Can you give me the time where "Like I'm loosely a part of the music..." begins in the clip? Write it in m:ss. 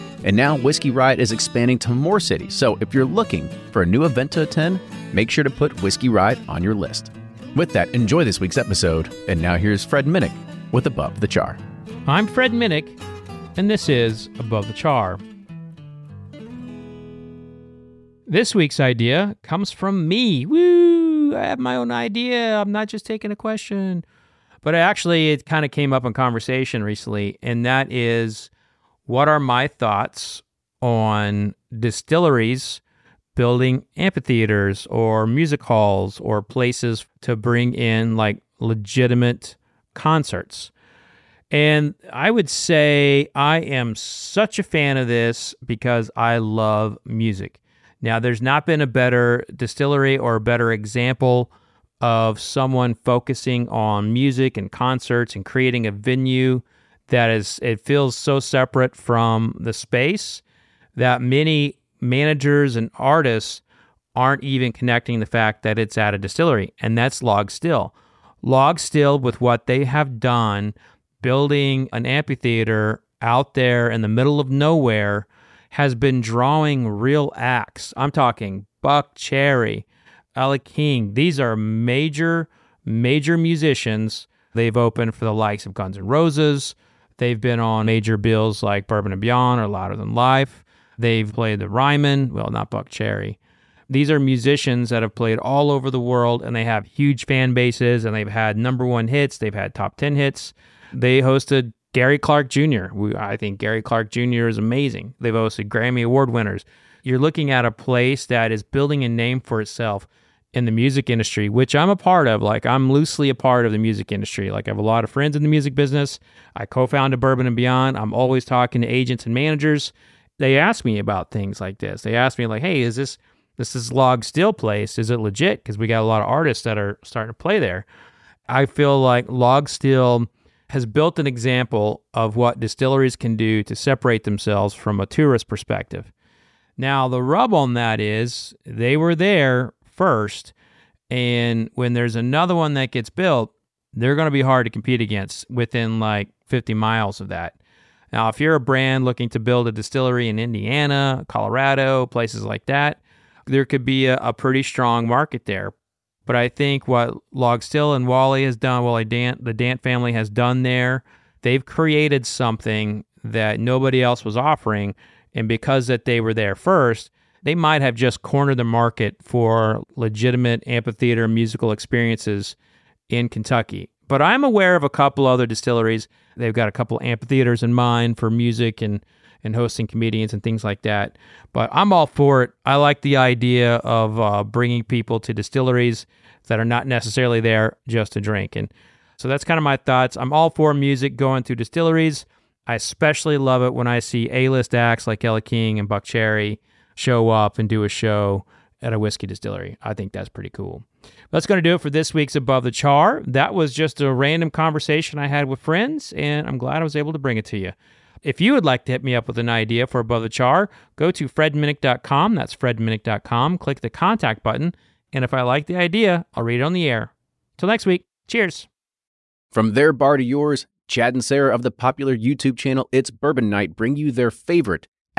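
1:52.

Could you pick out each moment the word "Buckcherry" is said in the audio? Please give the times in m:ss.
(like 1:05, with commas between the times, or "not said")
1:18, 1:32, 3:15.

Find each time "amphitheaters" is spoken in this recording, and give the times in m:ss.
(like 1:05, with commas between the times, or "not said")
0:33, 1:12, 2:50, 2:57.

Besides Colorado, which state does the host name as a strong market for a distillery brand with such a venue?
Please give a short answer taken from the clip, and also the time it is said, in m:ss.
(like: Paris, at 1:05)
Indiana, at 2:30.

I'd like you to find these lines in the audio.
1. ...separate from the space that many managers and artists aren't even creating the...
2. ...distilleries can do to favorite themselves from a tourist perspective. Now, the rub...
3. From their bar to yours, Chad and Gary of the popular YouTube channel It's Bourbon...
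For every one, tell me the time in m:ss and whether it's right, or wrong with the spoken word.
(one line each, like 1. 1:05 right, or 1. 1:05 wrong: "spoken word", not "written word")
1. 0:58 wrong: "connecting", not "creating"
2. 2:12 wrong: "separate", not "favorite"
3. 3:39 wrong: "Sarah", not "Gary".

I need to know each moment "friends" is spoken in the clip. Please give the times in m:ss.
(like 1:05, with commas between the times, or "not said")
1:55, 3:25.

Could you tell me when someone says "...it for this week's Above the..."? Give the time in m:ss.
3:21.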